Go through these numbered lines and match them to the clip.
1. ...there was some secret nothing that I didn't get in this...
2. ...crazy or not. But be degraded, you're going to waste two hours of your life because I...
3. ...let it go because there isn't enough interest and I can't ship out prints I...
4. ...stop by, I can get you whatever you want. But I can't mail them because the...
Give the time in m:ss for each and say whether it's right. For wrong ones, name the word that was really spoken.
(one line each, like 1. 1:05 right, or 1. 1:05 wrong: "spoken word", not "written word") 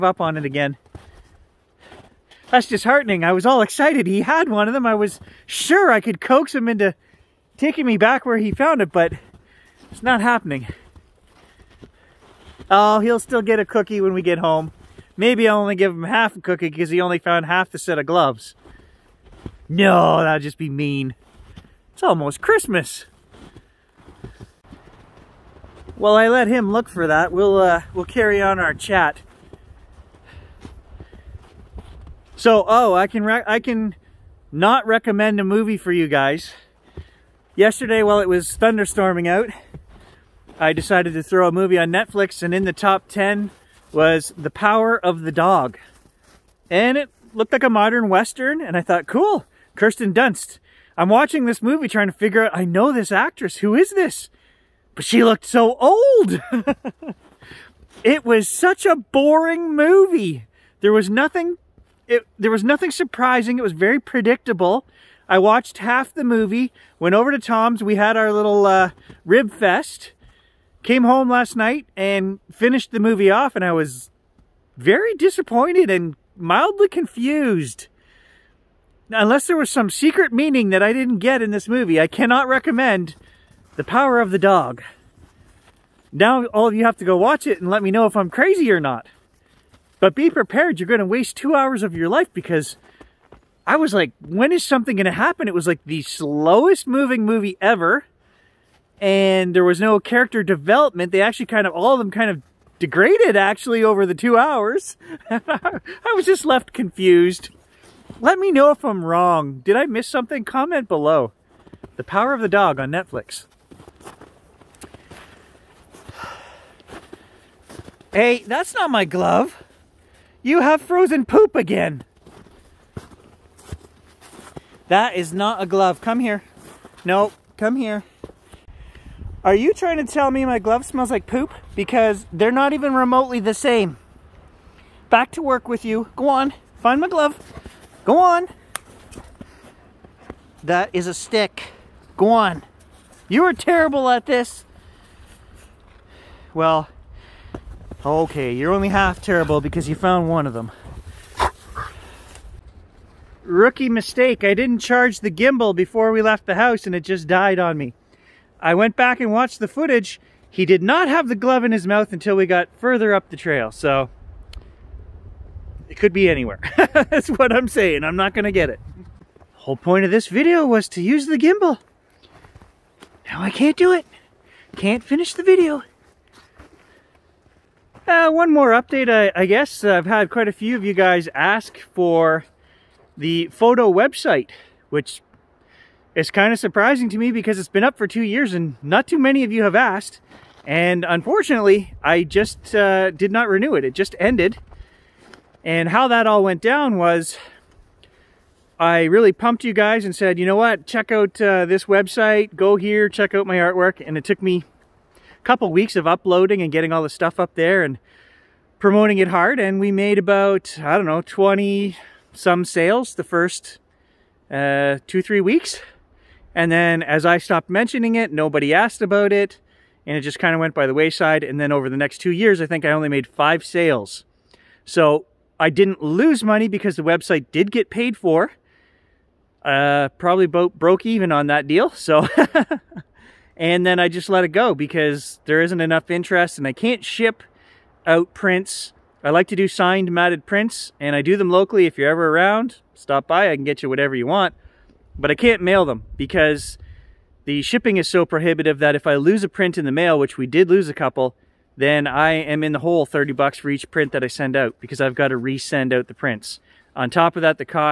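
1. 1:19 wrong: "meaning", not "nothing"
2. 1:28 wrong: "prepared", not "degraded"
3. 3:54 right
4. 4:02 right.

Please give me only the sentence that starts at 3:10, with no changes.
And unfortunately, I just uh, did not renew it.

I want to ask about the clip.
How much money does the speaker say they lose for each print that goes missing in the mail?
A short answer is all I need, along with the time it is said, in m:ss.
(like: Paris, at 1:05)
$30, at 4:13.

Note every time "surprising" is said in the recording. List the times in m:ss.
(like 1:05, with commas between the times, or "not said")
1:02, 3:06.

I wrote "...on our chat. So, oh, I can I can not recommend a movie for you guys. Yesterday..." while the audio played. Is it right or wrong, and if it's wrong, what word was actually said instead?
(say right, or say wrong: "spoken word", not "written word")
right.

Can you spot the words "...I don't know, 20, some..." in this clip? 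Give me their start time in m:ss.
3:30.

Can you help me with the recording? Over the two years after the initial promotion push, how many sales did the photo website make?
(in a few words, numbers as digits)
5.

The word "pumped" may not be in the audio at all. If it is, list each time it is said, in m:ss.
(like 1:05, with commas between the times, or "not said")
3:19.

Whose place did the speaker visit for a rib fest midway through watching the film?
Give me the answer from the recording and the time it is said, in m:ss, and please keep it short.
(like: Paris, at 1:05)
Tom's, at 1:07.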